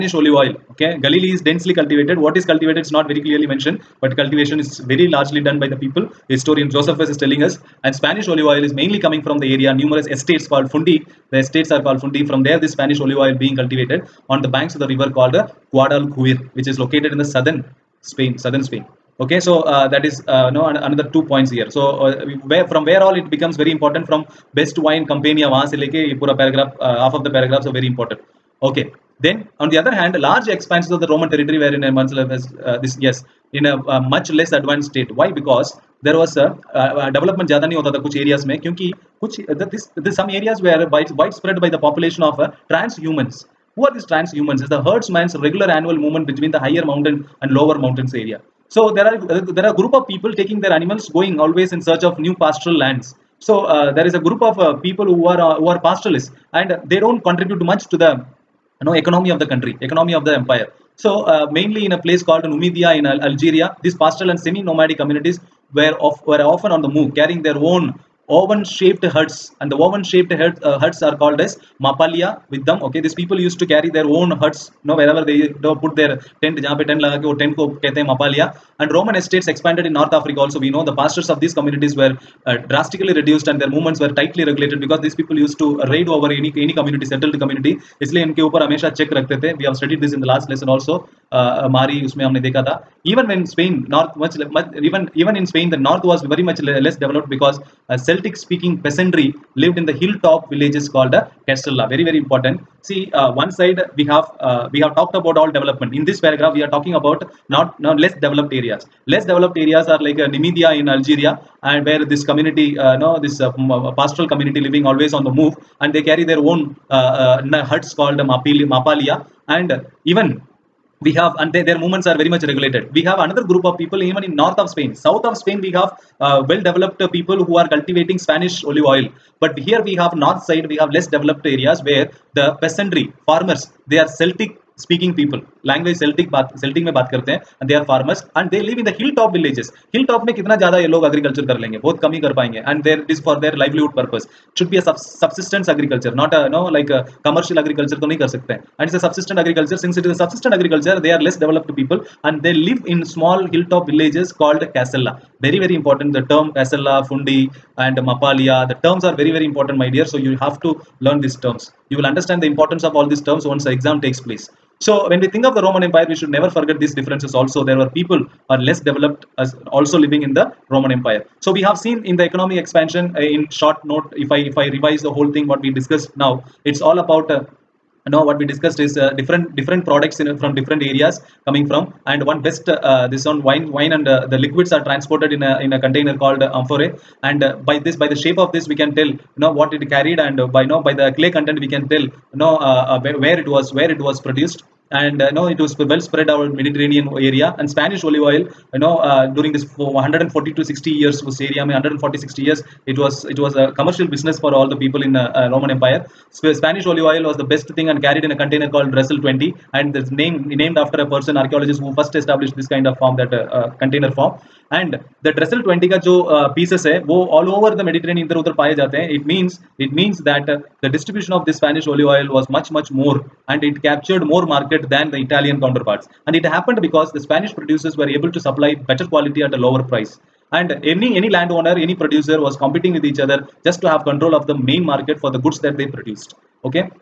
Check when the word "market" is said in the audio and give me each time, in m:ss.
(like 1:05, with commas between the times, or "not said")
3:44, 3:54.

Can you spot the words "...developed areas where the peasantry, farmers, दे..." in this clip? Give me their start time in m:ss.
2:11.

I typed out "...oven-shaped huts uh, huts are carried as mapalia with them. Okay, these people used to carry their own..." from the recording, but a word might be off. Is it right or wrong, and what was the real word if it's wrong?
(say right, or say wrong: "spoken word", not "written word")
wrong: "called", not "carried".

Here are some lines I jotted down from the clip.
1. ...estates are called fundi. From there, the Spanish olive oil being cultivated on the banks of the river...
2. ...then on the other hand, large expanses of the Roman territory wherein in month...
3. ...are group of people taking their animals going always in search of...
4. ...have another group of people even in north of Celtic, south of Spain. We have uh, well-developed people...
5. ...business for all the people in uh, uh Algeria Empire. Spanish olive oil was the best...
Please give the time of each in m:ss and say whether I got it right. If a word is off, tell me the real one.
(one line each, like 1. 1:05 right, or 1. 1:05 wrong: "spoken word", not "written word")
1. 0:11 right
2. 0:29 right
3. 0:49 right
4. 2:03 wrong: "Spain", not "Celtic"
5. 3:24 wrong: "Roman", not "Algeria".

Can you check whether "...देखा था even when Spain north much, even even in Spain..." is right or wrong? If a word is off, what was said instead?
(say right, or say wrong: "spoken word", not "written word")
right.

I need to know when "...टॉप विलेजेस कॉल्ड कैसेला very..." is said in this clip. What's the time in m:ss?
2:33.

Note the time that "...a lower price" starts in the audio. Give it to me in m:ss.
3:49.